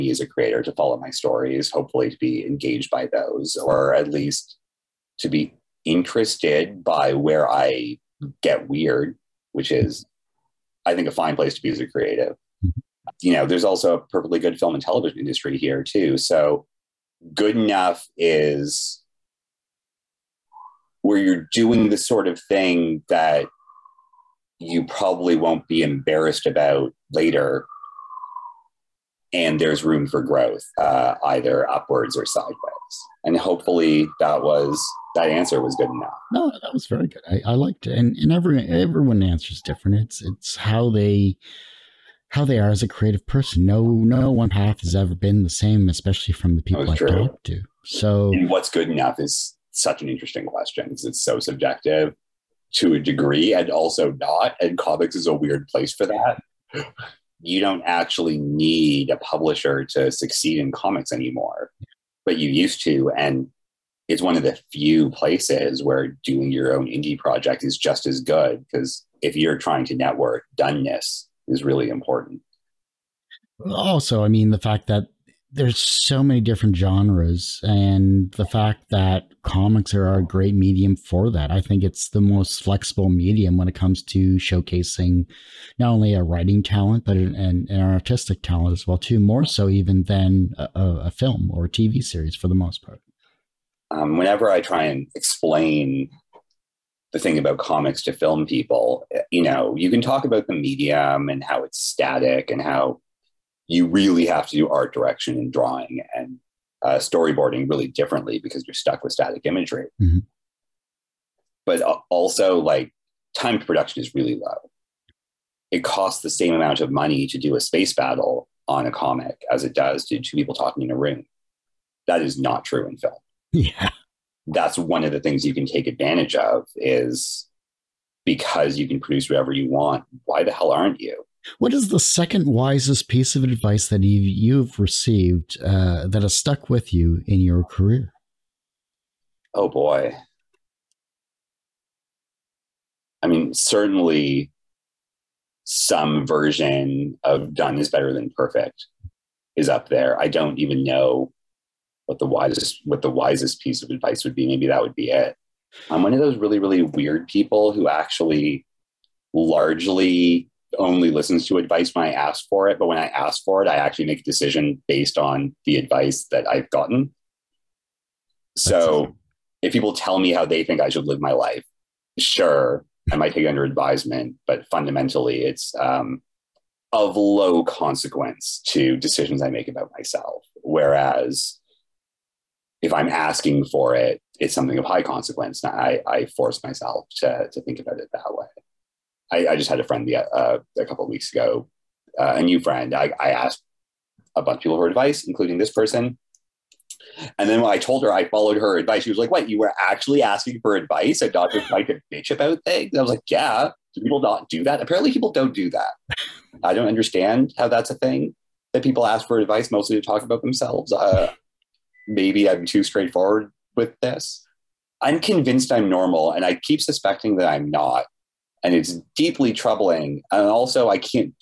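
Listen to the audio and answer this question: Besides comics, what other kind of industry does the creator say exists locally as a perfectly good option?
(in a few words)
film and television.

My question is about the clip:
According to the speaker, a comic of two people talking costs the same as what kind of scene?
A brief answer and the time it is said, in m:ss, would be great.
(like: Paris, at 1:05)
a space battle, at 1:57.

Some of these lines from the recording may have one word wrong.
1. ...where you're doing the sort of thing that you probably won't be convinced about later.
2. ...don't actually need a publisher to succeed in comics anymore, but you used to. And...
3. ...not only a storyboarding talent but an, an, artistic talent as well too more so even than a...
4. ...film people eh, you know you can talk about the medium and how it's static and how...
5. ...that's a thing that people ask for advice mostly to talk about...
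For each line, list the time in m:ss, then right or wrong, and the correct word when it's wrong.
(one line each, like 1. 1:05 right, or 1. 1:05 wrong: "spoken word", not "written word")
1. 0:21 wrong: "embarrassed", not "convinced"
2. 0:57 right
3. 1:25 wrong: "writing", not "storyboarding"
4. 1:38 right
5. 3:27 right.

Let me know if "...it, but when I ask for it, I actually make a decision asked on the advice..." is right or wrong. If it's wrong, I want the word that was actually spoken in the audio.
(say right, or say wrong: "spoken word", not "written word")
wrong: "based", not "asked".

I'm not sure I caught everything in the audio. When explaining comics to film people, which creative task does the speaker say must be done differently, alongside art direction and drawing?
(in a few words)
storyboarding.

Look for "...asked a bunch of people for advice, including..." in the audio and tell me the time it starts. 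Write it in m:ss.
3:13.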